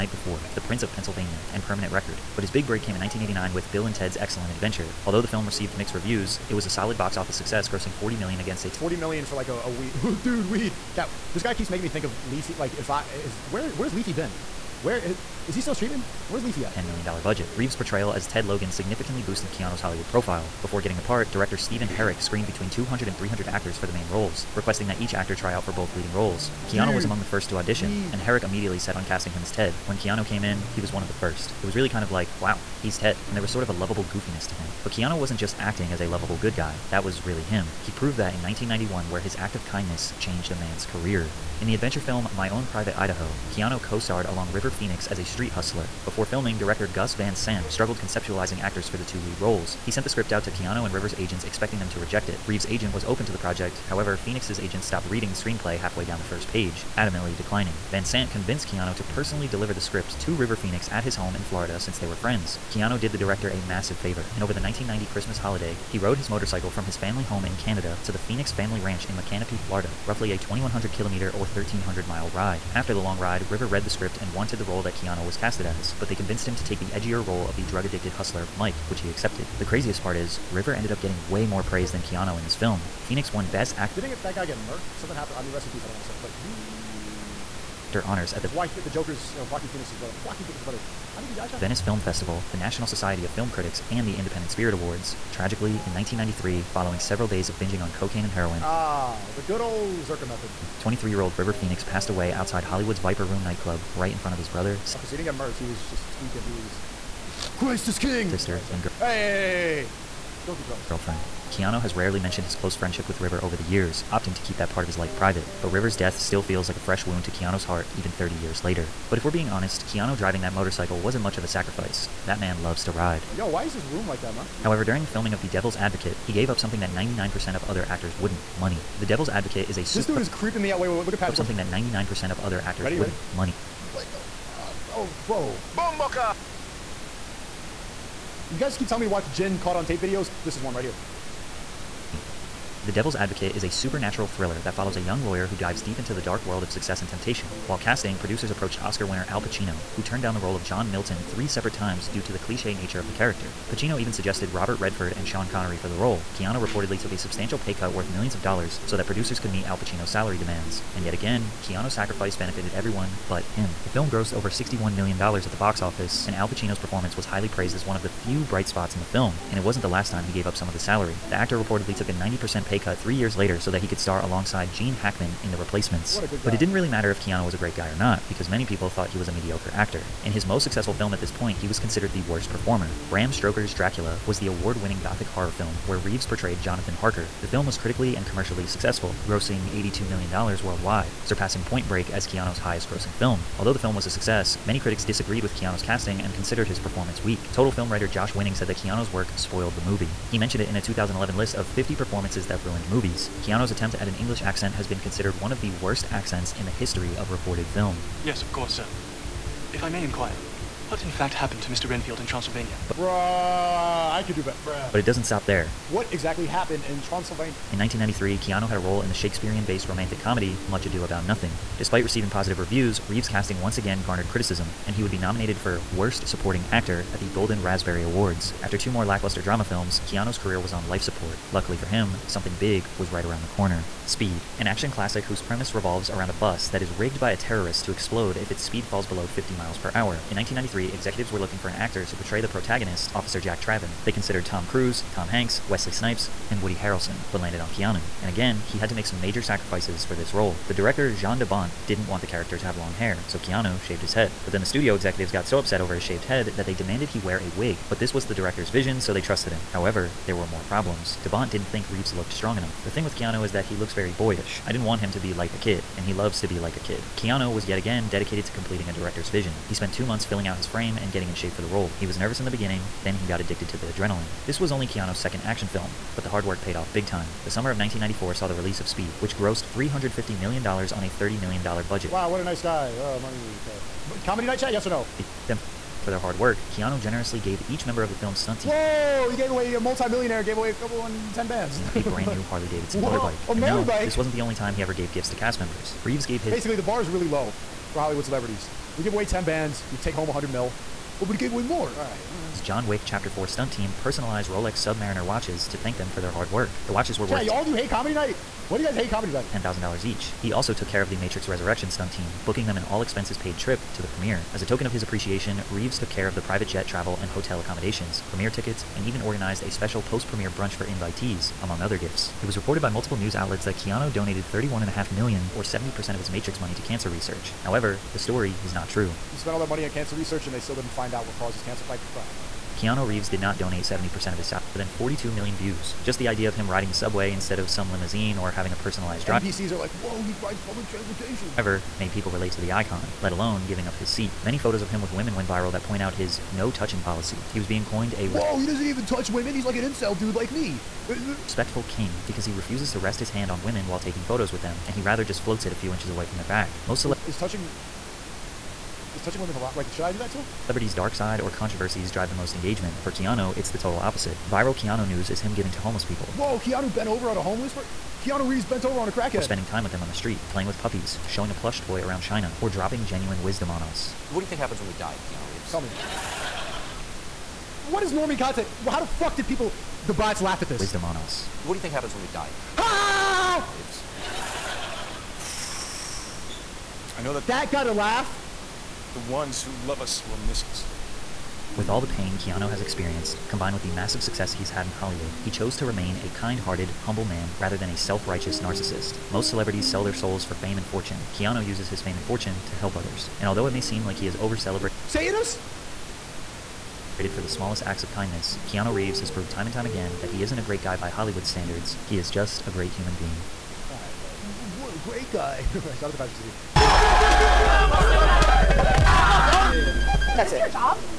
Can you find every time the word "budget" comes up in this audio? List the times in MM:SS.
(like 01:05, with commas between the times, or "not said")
00:17, 04:41.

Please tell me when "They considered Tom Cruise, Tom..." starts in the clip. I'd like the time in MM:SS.
04:04.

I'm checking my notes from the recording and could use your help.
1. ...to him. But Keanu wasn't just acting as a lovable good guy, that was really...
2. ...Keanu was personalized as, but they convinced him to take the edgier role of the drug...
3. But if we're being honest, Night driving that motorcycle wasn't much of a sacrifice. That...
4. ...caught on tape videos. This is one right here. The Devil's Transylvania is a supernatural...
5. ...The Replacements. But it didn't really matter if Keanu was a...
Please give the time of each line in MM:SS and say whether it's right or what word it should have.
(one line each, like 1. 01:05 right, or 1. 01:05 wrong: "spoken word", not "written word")
1. 00:34 right
2. 01:14 wrong: "casted", not "personalized"
3. 01:59 wrong: "Keanu", not "Night"
4. 02:19 wrong: "Advocate", not "Transylvania"
5. 02:55 right.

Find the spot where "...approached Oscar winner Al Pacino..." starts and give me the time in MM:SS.
02:28.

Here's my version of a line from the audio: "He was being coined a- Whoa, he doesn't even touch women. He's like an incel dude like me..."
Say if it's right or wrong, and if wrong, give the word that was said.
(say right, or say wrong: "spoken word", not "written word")
right.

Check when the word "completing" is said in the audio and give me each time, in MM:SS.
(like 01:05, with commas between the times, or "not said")
04:28.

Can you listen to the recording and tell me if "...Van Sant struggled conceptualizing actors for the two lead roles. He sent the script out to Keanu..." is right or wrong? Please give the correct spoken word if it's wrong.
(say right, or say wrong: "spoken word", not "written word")
right.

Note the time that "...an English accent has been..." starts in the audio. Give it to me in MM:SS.
03:24.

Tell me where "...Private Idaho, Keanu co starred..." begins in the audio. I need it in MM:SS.
00:42.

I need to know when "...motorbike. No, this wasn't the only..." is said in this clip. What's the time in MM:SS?
04:53.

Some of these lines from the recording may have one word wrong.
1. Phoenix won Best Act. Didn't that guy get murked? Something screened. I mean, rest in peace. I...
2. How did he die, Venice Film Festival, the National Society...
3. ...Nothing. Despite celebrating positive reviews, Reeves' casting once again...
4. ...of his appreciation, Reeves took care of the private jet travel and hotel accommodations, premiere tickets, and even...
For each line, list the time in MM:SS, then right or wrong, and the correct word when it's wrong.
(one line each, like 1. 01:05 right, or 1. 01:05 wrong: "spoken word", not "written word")
1. 01:23 wrong: "happened", not "screened"
2. 01:31 right
3. 03:41 wrong: "receiving", not "celebrating"
4. 05:14 right.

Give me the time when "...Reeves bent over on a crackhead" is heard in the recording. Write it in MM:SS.
06:08.